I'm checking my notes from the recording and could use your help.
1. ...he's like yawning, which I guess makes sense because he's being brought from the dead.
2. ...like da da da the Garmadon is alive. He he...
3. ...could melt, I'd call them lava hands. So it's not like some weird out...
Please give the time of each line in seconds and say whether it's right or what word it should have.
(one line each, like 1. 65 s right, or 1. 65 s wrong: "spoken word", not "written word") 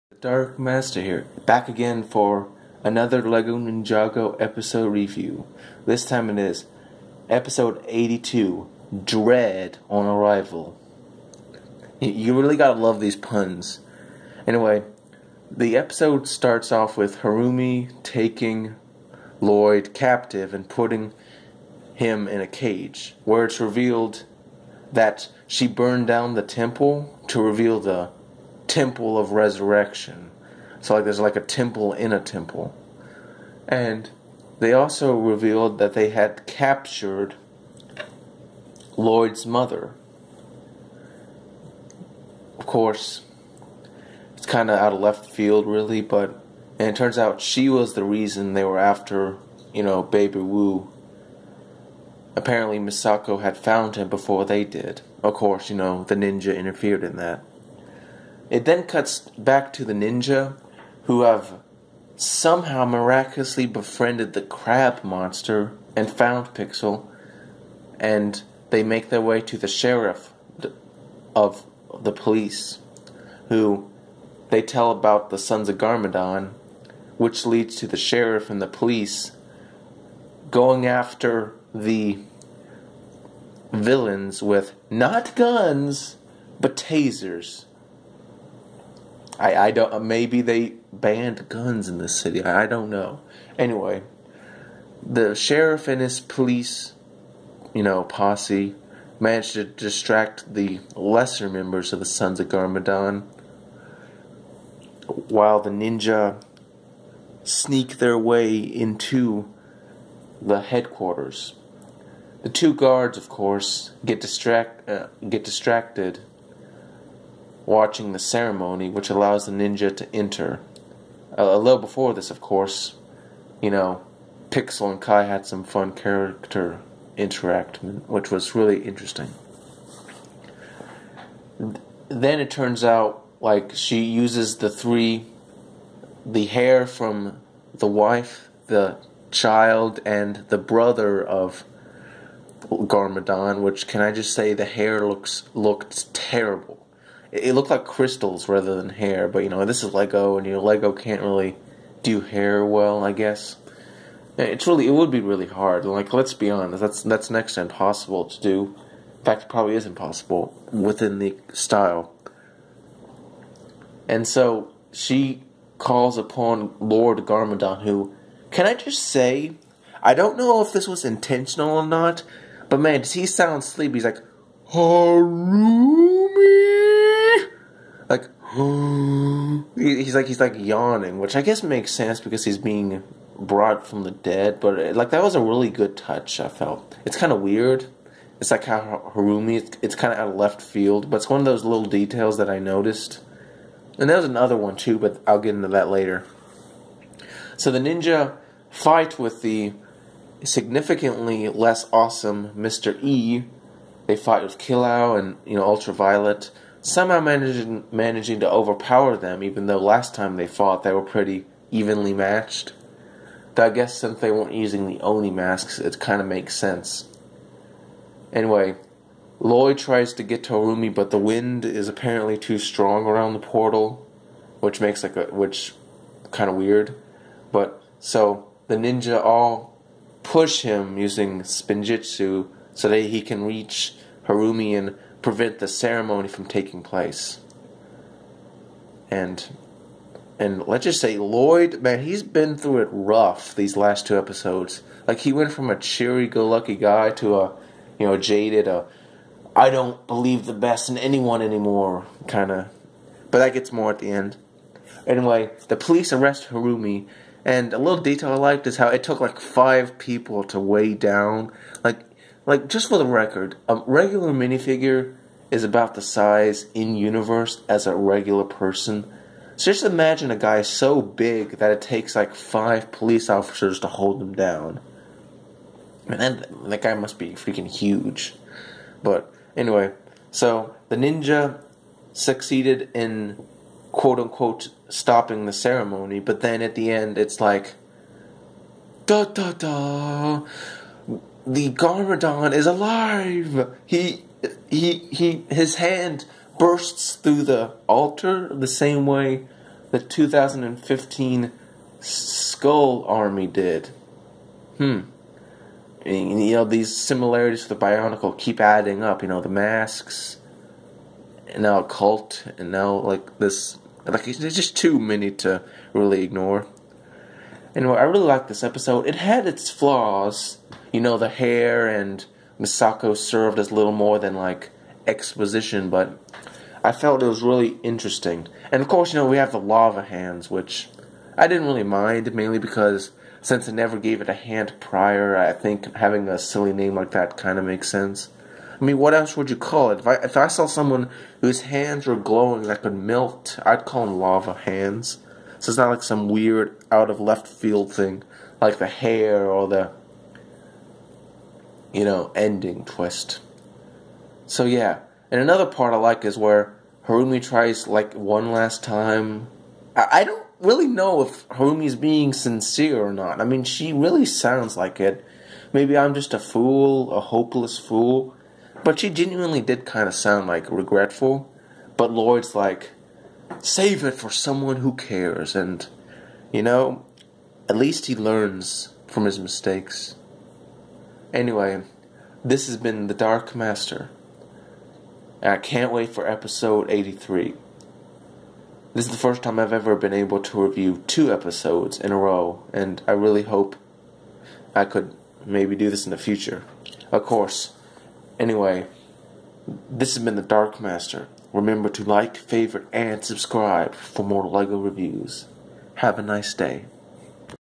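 1. 180 s right
2. 287 s right
3. 342 s right.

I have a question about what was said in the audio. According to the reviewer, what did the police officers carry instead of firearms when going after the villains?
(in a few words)
Tasers.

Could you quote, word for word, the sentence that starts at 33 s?
And they also revealed that they had captured Lloyd's mother.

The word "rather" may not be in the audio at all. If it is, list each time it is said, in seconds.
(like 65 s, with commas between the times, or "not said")
148 s.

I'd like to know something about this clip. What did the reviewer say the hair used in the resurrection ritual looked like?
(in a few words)
Crystals.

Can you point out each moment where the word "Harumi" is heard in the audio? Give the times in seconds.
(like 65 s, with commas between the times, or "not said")
17 s, 174 s, 189 s, 220 s, 234 s, 256 s, 357 s, 361 s.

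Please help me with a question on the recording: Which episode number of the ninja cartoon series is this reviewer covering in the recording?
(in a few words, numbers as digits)
82.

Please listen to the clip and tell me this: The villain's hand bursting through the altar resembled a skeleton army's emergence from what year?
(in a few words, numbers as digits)
2015.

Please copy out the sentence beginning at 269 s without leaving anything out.
So just imagine a guy so big that it takes like five police officers to hold him down.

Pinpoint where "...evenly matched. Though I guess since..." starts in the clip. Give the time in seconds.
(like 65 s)
211 s.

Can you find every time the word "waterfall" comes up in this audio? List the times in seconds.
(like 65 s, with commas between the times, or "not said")
not said.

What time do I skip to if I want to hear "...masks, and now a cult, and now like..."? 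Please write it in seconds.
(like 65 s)
309 s.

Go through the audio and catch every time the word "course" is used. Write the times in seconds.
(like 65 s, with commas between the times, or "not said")
42 s, 55 s, 113 s, 122 s, 328 s, 397 s.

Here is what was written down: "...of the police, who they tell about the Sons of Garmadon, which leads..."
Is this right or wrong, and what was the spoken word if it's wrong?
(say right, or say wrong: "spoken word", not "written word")
right.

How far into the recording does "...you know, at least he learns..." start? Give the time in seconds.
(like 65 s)
376 s.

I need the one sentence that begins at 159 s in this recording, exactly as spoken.
In fact, it probably is impossible within the style.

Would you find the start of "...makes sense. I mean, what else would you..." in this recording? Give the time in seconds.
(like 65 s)
337 s.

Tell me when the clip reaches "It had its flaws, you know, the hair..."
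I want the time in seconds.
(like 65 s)
319 s.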